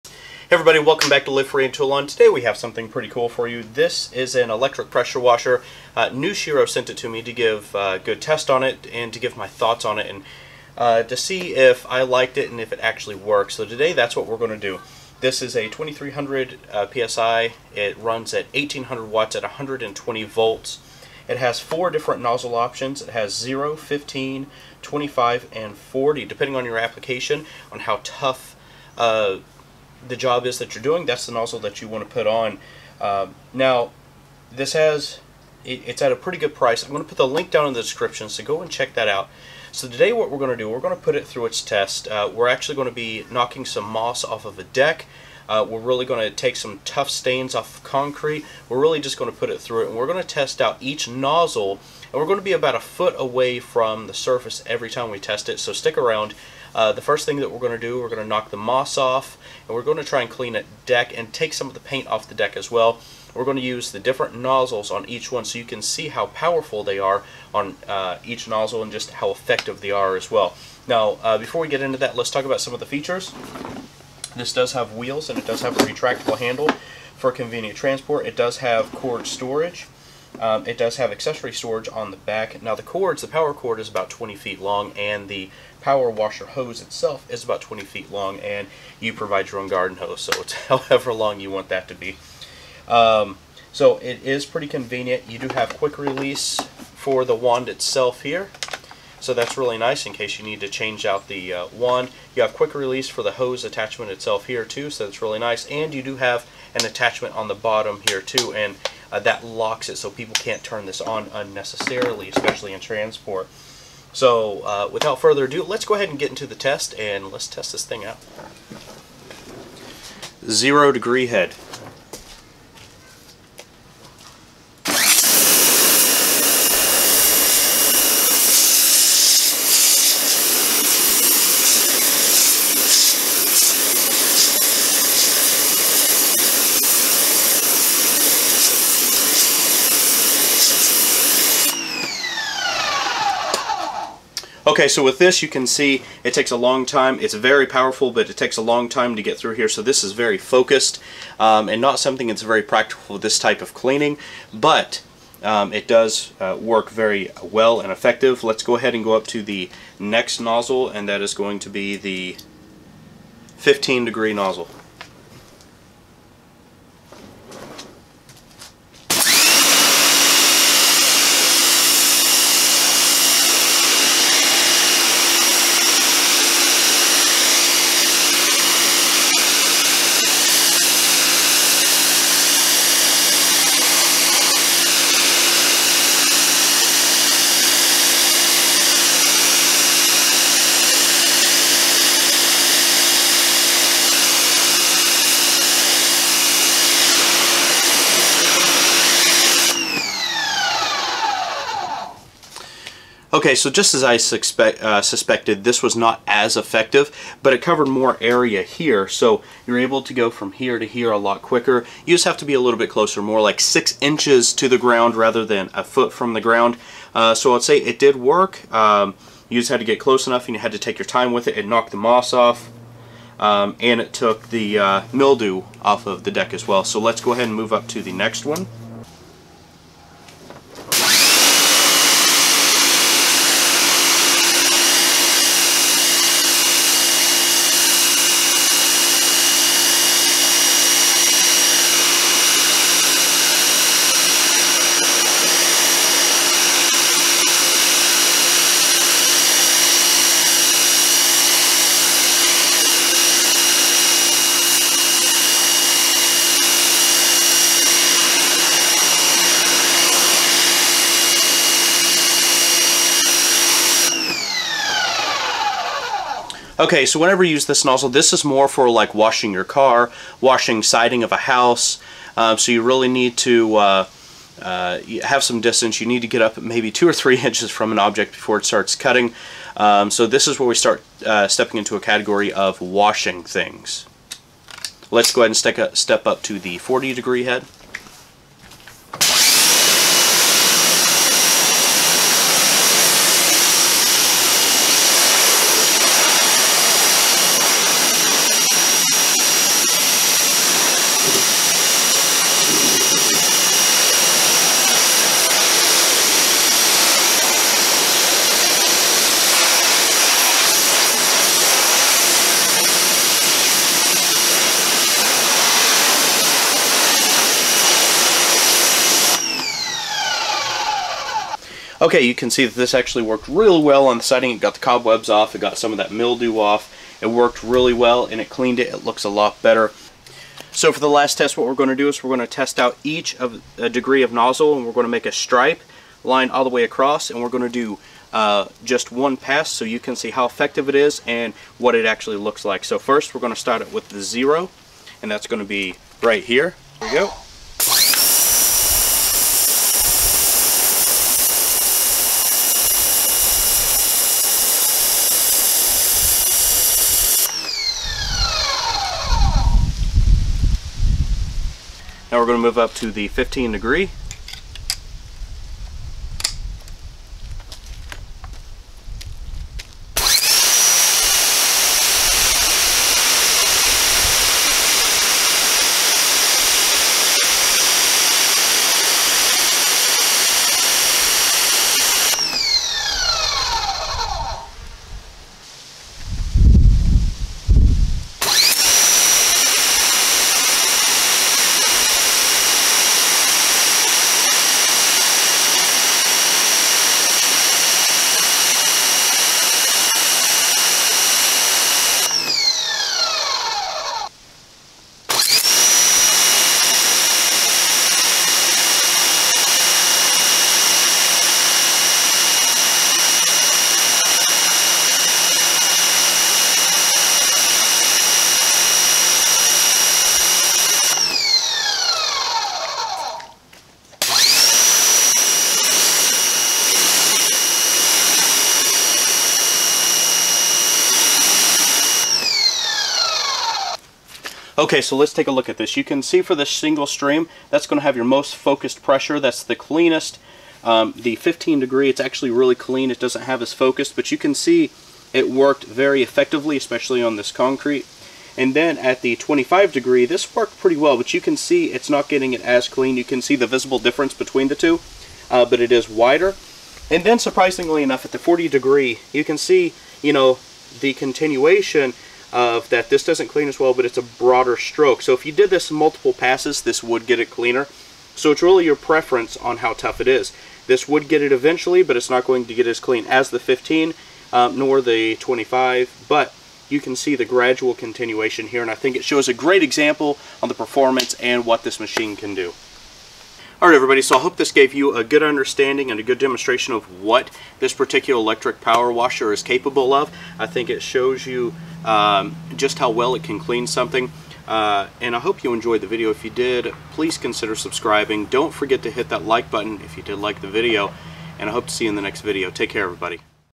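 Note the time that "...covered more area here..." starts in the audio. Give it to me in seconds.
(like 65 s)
207 s.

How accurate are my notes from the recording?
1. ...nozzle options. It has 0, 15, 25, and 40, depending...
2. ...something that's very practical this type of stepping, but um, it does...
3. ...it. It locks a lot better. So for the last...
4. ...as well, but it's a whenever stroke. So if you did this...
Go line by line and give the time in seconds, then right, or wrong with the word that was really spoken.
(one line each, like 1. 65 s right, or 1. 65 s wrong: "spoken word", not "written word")
1. 22 s right
2. 151 s wrong: "cleaning", not "stepping"
3. 328 s wrong: "looks", not "locks"
4. 463 s wrong: "broader", not "whenever".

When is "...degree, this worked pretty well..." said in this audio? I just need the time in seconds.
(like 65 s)
449 s.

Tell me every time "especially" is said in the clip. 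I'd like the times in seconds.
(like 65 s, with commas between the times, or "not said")
112 s, 446 s.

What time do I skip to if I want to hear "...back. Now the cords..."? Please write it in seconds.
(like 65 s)
82 s.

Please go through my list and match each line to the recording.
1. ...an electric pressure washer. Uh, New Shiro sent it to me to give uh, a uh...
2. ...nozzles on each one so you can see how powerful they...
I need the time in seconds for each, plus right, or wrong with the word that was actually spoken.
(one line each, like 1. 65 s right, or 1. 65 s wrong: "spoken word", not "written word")
1. 4 s right
2. 64 s right.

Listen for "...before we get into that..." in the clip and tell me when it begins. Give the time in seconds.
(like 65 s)
71 s.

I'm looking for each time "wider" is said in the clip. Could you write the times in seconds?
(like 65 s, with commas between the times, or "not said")
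456 s.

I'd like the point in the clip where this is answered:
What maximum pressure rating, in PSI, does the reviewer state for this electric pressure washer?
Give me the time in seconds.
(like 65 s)
15 s.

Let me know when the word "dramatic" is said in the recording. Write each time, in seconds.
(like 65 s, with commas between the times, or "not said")
not said.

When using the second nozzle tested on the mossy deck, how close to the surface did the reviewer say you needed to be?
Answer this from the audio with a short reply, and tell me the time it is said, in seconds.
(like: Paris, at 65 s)
6 inches, at 213 s.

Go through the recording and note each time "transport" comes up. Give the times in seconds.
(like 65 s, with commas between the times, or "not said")
77 s, 112 s.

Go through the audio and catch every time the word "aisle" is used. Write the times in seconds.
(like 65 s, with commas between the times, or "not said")
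not said.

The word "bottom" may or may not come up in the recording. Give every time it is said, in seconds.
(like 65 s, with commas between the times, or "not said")
107 s.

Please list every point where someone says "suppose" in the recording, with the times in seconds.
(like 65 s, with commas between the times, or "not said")
not said.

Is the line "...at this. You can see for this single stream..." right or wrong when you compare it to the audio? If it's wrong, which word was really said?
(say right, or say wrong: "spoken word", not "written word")
right.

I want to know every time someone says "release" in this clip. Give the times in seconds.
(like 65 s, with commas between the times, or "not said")
95 s, 102 s.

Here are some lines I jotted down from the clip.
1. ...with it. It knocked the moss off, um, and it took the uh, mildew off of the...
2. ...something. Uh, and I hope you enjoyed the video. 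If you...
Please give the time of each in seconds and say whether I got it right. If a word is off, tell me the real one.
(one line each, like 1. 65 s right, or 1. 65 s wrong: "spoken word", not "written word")
1. 221 s right
2. 493 s right.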